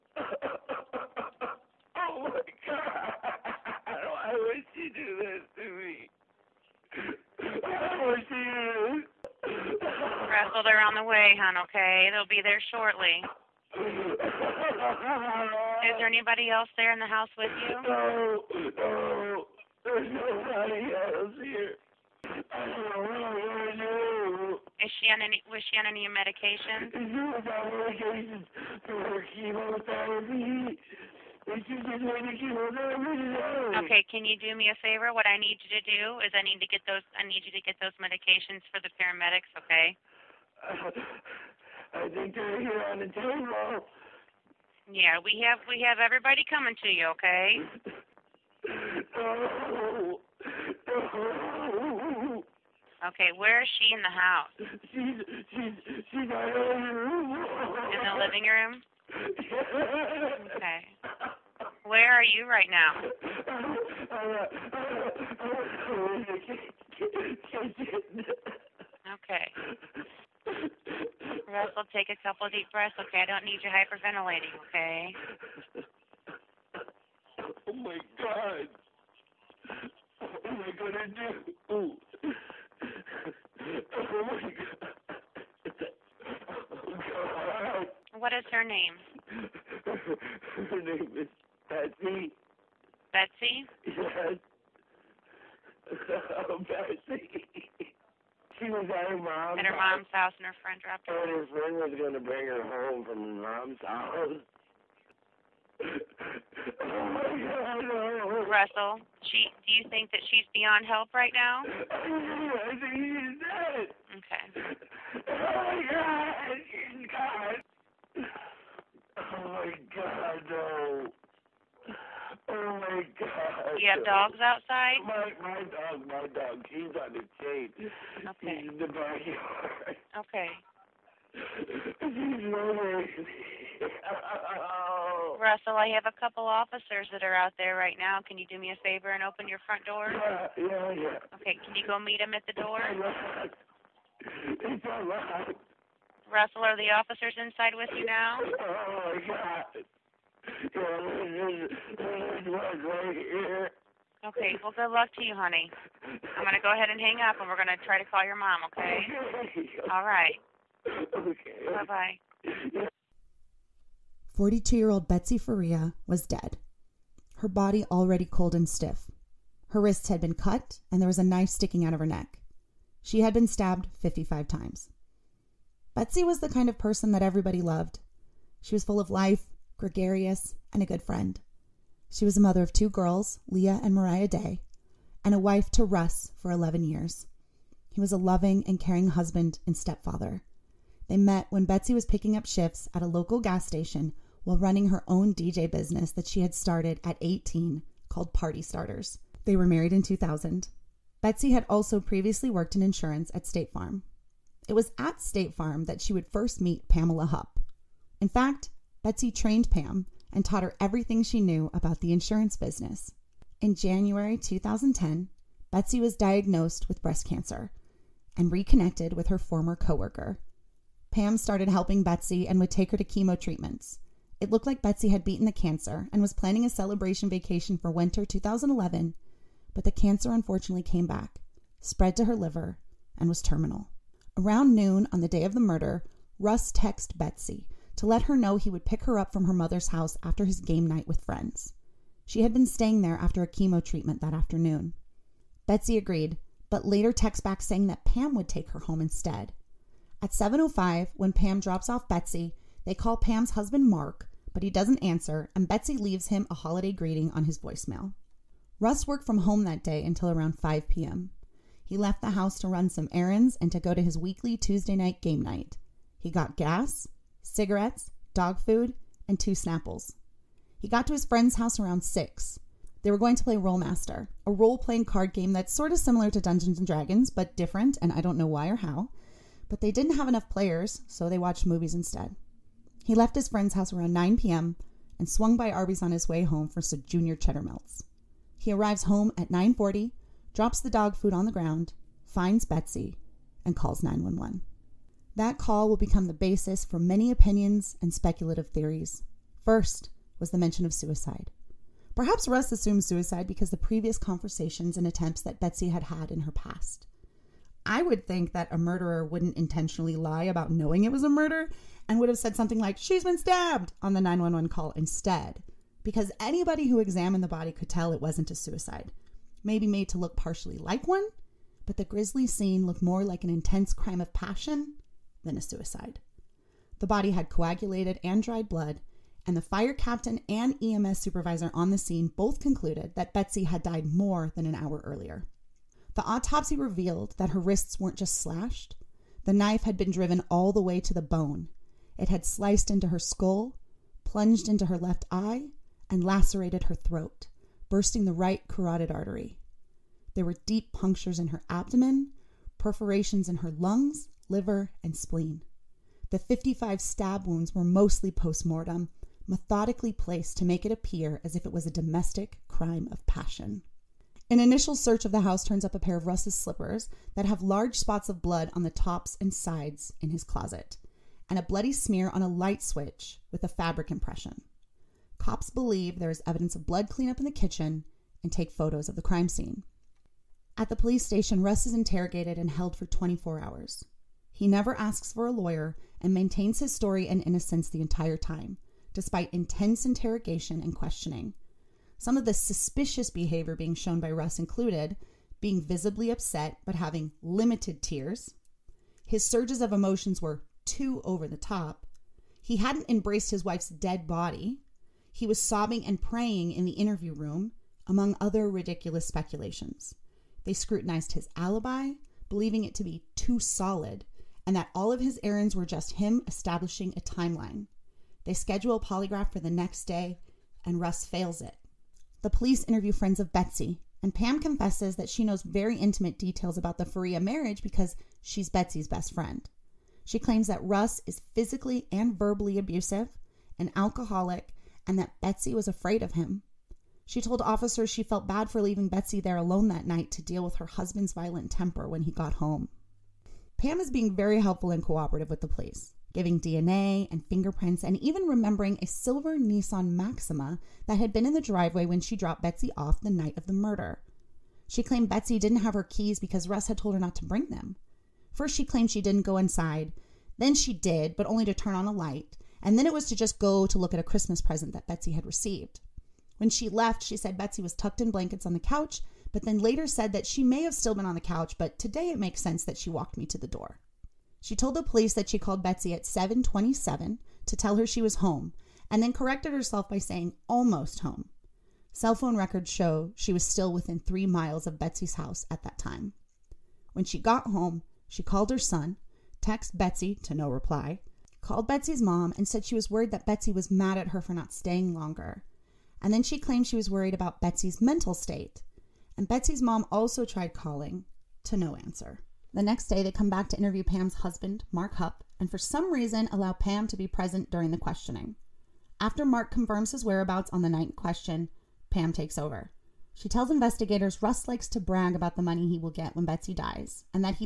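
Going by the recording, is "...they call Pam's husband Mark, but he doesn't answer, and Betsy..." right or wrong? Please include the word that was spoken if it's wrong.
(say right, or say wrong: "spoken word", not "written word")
right.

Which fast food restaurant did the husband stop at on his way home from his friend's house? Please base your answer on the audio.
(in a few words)
Arby's.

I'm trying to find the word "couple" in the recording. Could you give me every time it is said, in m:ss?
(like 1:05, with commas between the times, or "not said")
1:12, 2:16.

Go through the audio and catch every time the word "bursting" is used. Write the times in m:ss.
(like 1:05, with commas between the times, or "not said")
5:47.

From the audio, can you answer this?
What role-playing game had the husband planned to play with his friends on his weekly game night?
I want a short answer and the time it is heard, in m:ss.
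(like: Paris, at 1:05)
Rolemaster, at 4:33.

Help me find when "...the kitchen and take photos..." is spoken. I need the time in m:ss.
6:17.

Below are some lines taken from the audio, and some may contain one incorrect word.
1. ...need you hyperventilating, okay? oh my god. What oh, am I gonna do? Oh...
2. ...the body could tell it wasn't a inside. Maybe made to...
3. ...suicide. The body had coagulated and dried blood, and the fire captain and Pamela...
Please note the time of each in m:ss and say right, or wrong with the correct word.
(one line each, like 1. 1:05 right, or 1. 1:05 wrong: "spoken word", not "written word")
1. 1:13 right
2. 5:17 wrong: "suicide", not "inside"
3. 5:25 wrong: "EMS", not "Pamela".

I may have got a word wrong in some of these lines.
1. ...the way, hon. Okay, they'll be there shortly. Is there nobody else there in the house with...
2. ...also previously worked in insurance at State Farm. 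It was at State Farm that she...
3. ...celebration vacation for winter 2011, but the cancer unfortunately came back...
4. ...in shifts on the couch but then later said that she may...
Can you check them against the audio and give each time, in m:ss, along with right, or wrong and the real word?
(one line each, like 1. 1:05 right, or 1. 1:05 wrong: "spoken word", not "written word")
1. 0:10 wrong: "anybody", not "nobody"
2. 3:21 right
3. 3:46 right
4. 7:48 wrong: "blankets", not "shifts".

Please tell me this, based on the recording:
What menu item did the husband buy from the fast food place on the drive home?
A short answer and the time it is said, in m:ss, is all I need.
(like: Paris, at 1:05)
junior cheddar melts, at 4:47.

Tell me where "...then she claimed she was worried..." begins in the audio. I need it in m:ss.
8:16.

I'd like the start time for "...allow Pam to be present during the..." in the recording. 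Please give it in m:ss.
8:26.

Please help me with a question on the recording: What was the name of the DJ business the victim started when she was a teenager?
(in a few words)
Party Starters.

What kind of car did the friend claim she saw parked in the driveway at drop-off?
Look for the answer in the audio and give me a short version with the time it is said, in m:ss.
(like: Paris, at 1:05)
silver Nissan Maxima, at 7:29.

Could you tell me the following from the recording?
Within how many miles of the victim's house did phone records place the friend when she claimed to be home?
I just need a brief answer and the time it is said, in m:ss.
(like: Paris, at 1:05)
3, at 8:04.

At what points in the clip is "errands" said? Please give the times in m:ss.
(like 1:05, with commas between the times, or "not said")
4:23, 6:55.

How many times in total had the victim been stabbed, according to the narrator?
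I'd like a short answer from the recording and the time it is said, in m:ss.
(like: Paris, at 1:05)
55, at 2:53.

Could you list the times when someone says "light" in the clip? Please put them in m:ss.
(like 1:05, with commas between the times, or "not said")
6:12, 7:42.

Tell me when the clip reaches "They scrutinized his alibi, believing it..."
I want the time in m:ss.
6:50.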